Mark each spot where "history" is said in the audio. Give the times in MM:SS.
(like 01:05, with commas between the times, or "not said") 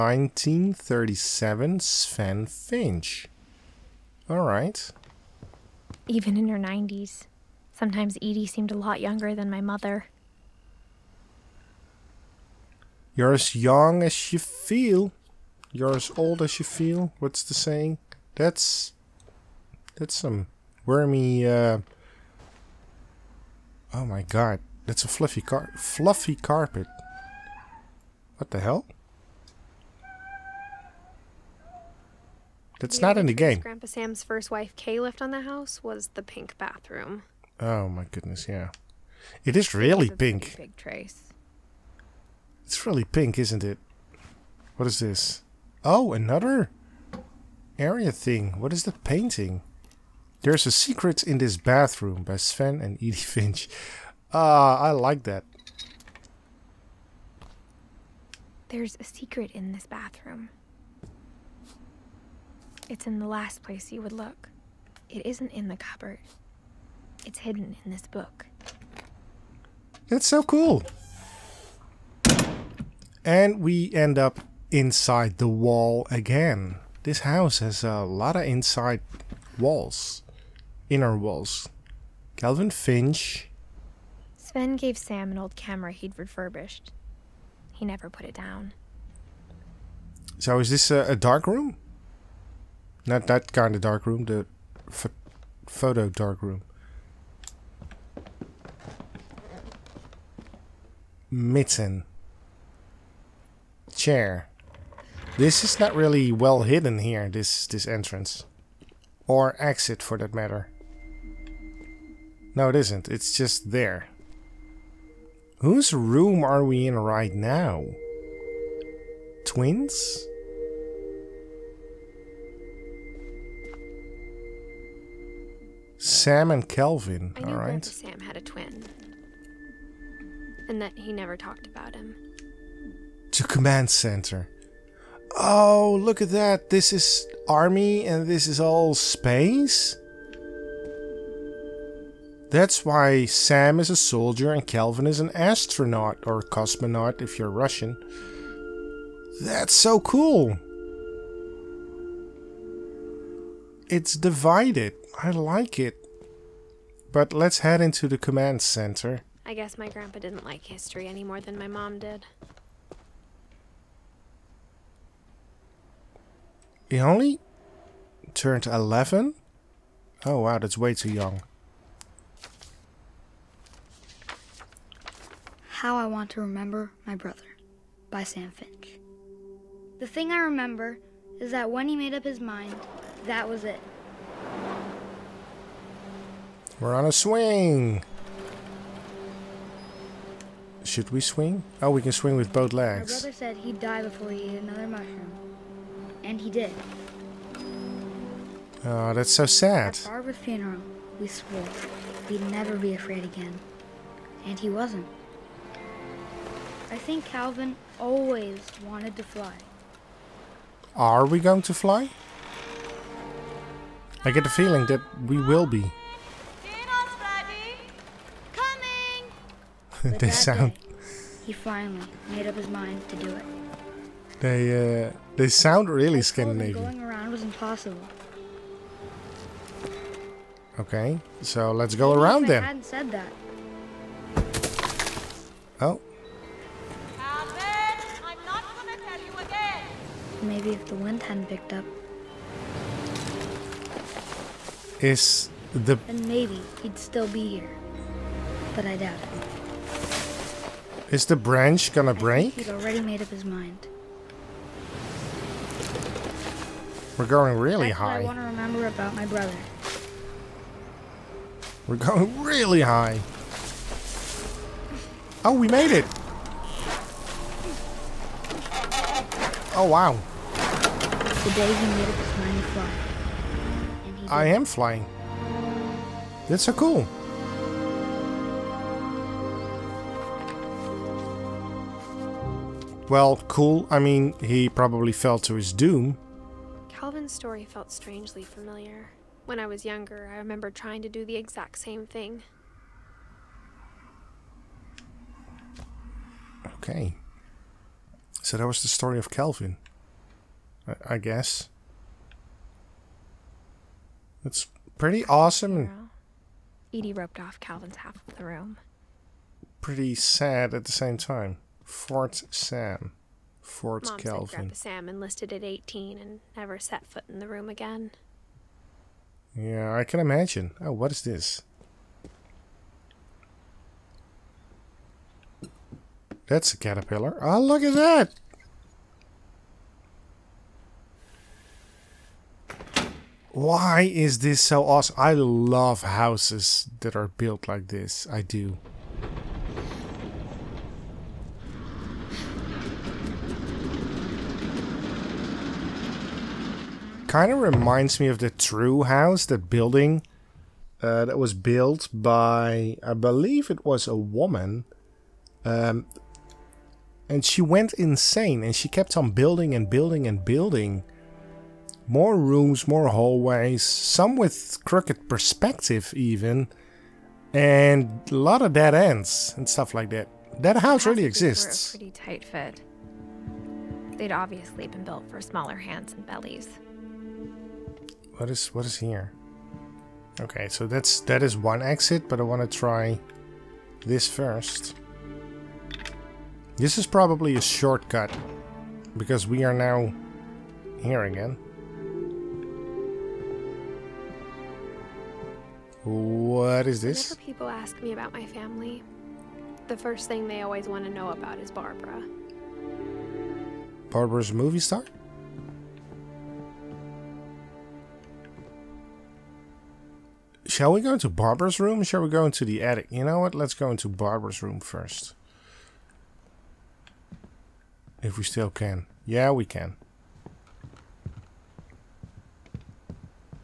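02:40.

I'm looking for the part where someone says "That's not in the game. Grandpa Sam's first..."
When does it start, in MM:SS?
00:32.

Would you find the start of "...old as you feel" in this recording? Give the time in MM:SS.
00:16.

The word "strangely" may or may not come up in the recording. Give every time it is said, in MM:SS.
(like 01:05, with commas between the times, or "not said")
04:47.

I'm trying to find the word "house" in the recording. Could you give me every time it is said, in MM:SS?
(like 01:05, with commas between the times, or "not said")
00:35, 01:17, 05:36, 05:49, 06:10.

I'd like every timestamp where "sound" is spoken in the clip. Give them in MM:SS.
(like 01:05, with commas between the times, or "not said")
03:40, 03:45.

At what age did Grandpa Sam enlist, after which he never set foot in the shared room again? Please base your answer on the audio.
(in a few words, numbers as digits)
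18.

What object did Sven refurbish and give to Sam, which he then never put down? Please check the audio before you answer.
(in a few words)
old camera.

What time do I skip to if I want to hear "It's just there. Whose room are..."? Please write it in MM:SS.
01:53.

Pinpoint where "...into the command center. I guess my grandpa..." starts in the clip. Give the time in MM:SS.
02:37.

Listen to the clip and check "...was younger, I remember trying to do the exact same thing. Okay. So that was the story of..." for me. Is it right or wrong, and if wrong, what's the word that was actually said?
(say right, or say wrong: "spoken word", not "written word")
right.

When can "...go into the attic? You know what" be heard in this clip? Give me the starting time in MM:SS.
06:52.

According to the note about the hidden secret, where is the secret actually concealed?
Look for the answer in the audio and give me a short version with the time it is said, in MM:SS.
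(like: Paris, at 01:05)
in this book, at 01:07.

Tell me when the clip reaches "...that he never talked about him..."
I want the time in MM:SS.
02:10.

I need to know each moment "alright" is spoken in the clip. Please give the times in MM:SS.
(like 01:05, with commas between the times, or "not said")
00:04, 02:07.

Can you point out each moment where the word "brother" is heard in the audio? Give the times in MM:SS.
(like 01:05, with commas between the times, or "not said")
02:57, 03:13, 04:19.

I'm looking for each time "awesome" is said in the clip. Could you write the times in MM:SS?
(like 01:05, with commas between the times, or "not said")
05:05, 05:34.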